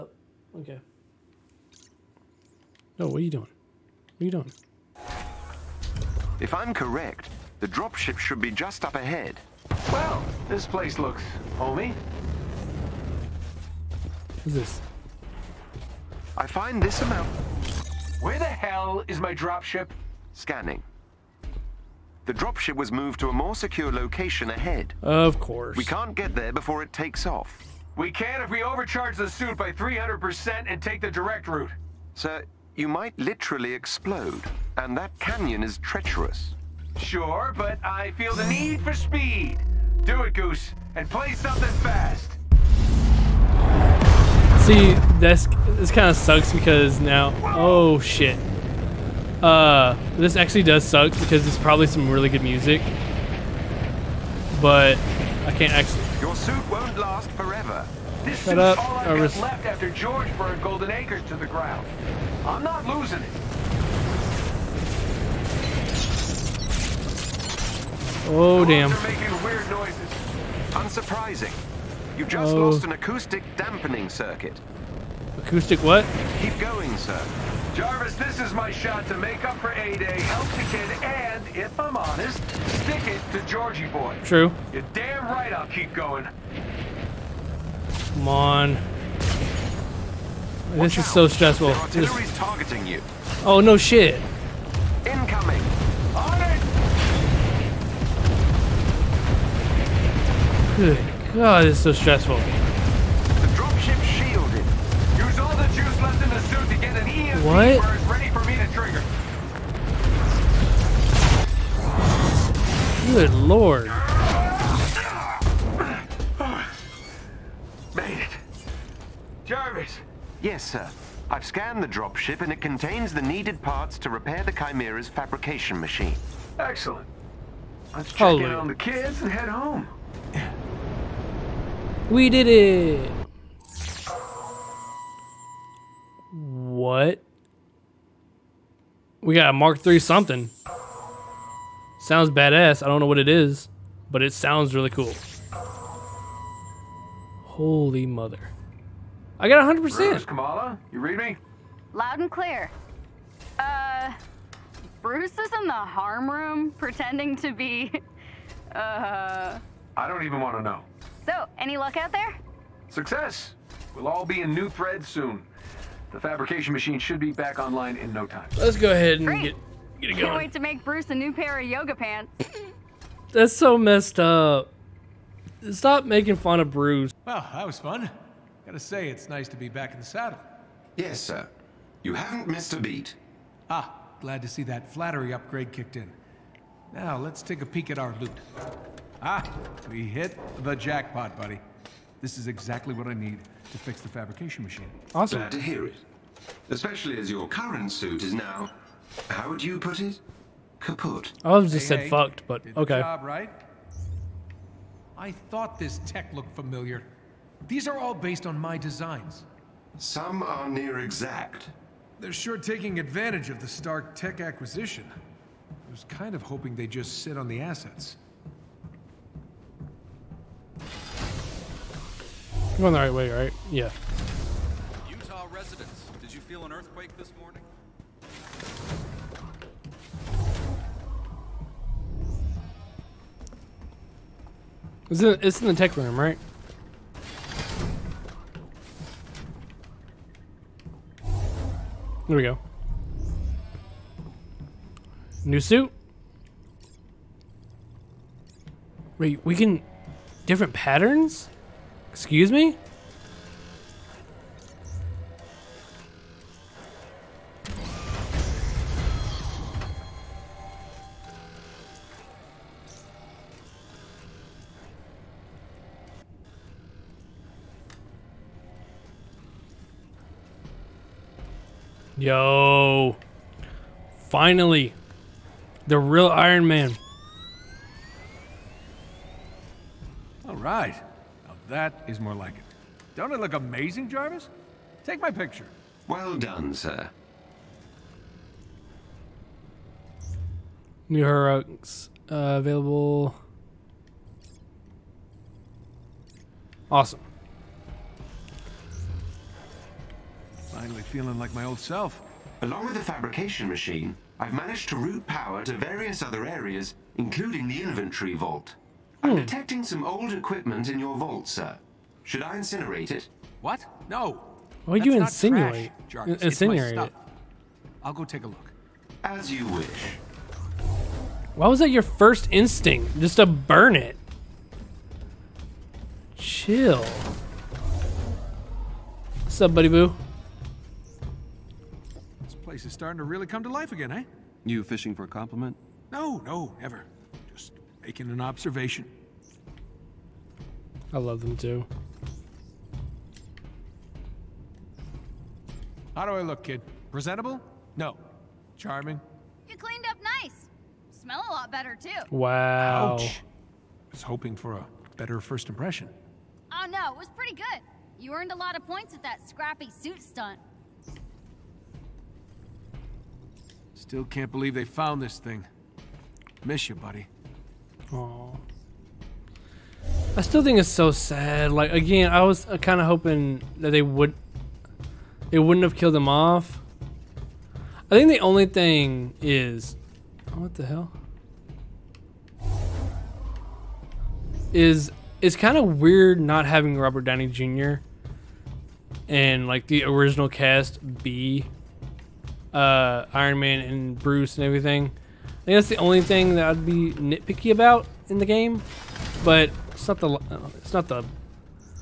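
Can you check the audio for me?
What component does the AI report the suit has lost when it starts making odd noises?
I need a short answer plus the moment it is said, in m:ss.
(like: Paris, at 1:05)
acoustic dampening circuit, at 1:12.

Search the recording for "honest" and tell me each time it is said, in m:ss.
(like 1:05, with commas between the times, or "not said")
1:21.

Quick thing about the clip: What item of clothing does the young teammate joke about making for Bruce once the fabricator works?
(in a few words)
yoga pants.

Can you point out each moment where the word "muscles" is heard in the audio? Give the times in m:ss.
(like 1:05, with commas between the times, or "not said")
not said.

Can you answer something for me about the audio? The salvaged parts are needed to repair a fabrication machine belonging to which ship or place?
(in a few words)
the Chimera.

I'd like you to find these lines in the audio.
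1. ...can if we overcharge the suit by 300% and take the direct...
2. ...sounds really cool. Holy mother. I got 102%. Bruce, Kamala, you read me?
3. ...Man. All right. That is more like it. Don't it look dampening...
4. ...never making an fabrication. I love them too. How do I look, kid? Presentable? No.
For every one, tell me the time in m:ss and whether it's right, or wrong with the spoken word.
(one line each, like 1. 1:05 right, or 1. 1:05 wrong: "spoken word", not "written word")
1. 0:28 right
2. 2:24 wrong: "100", not "102"
3. 4:36 wrong: "amazing", not "dampening"
4. 5:36 wrong: "observation", not "fabrication".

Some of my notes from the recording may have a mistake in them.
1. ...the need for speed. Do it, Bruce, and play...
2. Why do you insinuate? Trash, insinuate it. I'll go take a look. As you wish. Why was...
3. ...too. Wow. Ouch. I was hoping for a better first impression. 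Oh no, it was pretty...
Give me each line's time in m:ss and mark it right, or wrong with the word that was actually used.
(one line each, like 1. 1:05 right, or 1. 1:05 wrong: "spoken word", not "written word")
1. 0:38 wrong: "Goose", not "Bruce"
2. 5:14 right
3. 5:51 right.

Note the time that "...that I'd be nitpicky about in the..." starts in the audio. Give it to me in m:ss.
6:36.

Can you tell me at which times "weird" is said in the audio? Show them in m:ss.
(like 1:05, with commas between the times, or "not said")
1:09, 6:25.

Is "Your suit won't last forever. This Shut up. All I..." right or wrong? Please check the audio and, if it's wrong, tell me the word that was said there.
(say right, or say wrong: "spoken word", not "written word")
right.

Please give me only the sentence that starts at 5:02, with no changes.
Along with the fabrication machine, I've managed to route power to various other areas, including the inventory vault.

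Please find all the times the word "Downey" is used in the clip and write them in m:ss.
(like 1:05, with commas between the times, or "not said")
6:27.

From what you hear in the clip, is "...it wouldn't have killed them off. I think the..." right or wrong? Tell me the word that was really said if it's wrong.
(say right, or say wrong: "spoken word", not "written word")
right.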